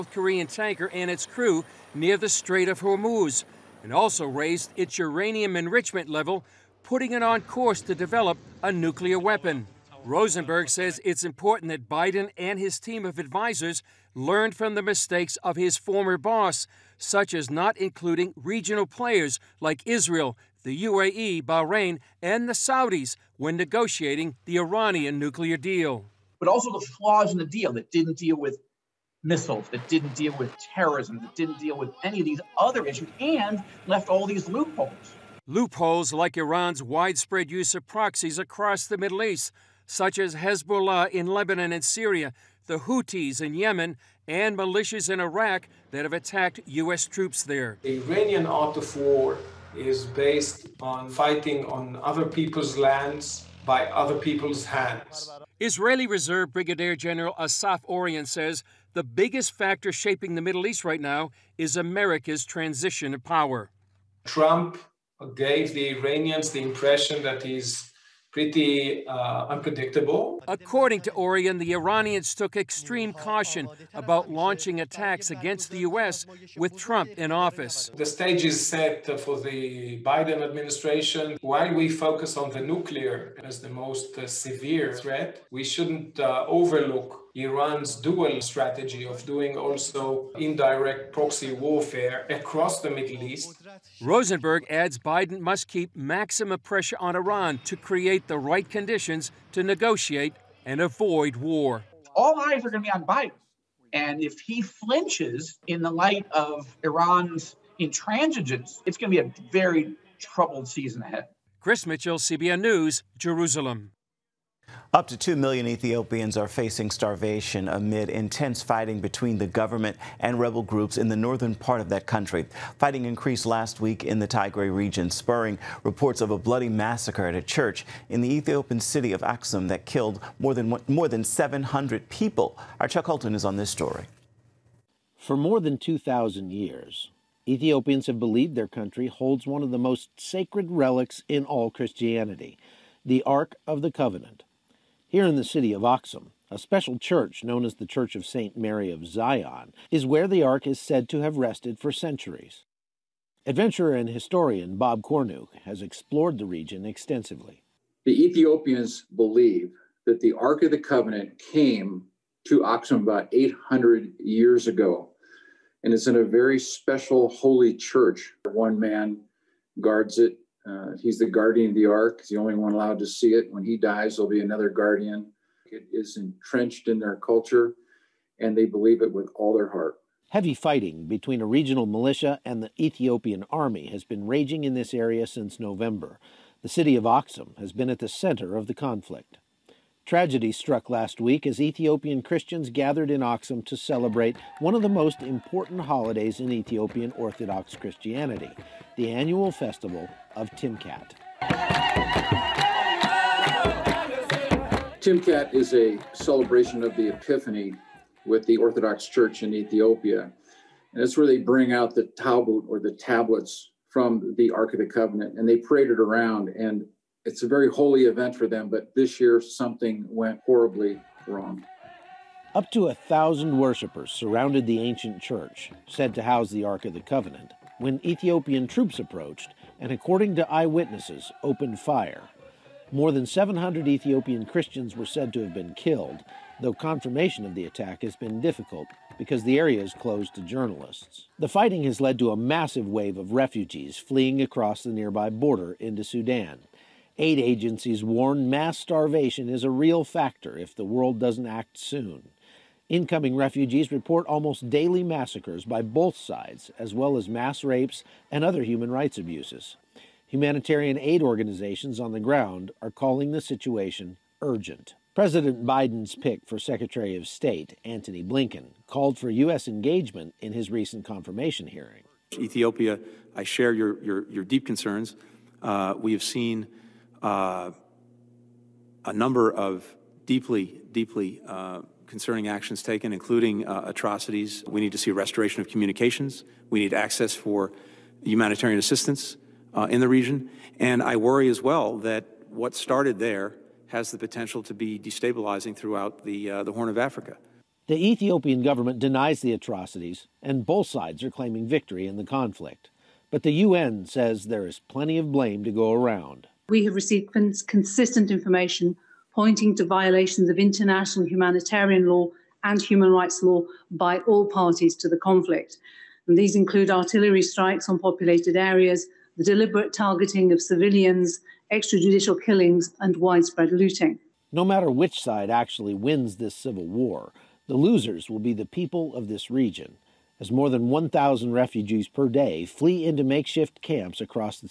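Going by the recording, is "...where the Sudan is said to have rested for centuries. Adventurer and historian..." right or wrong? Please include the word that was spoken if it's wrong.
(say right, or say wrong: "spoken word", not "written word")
wrong: "Ark", not "Sudan".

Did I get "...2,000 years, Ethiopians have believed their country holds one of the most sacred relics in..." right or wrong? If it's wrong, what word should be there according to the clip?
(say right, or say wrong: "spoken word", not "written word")
right.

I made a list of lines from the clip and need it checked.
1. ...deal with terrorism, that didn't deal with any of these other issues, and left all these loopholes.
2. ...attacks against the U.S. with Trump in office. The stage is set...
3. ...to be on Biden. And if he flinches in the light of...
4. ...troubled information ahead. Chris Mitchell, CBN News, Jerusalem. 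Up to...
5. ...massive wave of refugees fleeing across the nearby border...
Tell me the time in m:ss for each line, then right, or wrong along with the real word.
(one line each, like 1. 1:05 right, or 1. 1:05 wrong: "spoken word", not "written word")
1. 0:30 right
2. 1:14 right
3. 1:42 right
4. 1:50 wrong: "season", not "information"
5. 4:02 right.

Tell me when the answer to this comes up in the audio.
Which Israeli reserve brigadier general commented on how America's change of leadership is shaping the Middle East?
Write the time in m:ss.
0:57.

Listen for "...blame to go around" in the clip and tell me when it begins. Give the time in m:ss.
5:05.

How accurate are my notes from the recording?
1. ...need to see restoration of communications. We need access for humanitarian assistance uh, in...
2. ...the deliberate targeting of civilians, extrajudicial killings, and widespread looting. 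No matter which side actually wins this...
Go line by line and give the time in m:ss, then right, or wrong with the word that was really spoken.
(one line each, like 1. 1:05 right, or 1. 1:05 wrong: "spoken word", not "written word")
1. 4:44 right
2. 5:19 right.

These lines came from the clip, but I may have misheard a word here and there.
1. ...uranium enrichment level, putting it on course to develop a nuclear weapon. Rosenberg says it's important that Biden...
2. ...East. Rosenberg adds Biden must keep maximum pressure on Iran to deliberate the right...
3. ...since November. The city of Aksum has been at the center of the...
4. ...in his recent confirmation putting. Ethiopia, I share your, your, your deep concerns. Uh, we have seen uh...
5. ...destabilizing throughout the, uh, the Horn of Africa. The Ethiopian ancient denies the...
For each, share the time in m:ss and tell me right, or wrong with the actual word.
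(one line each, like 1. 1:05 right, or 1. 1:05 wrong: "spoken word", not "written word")
1. 0:04 right
2. 1:33 wrong: "create", not "deliberate"
3. 3:05 right
4. 4:30 wrong: "hearing", not "putting"
5. 4:54 wrong: "government", not "ancient".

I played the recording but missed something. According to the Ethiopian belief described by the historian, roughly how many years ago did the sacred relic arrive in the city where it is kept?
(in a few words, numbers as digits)
800 years.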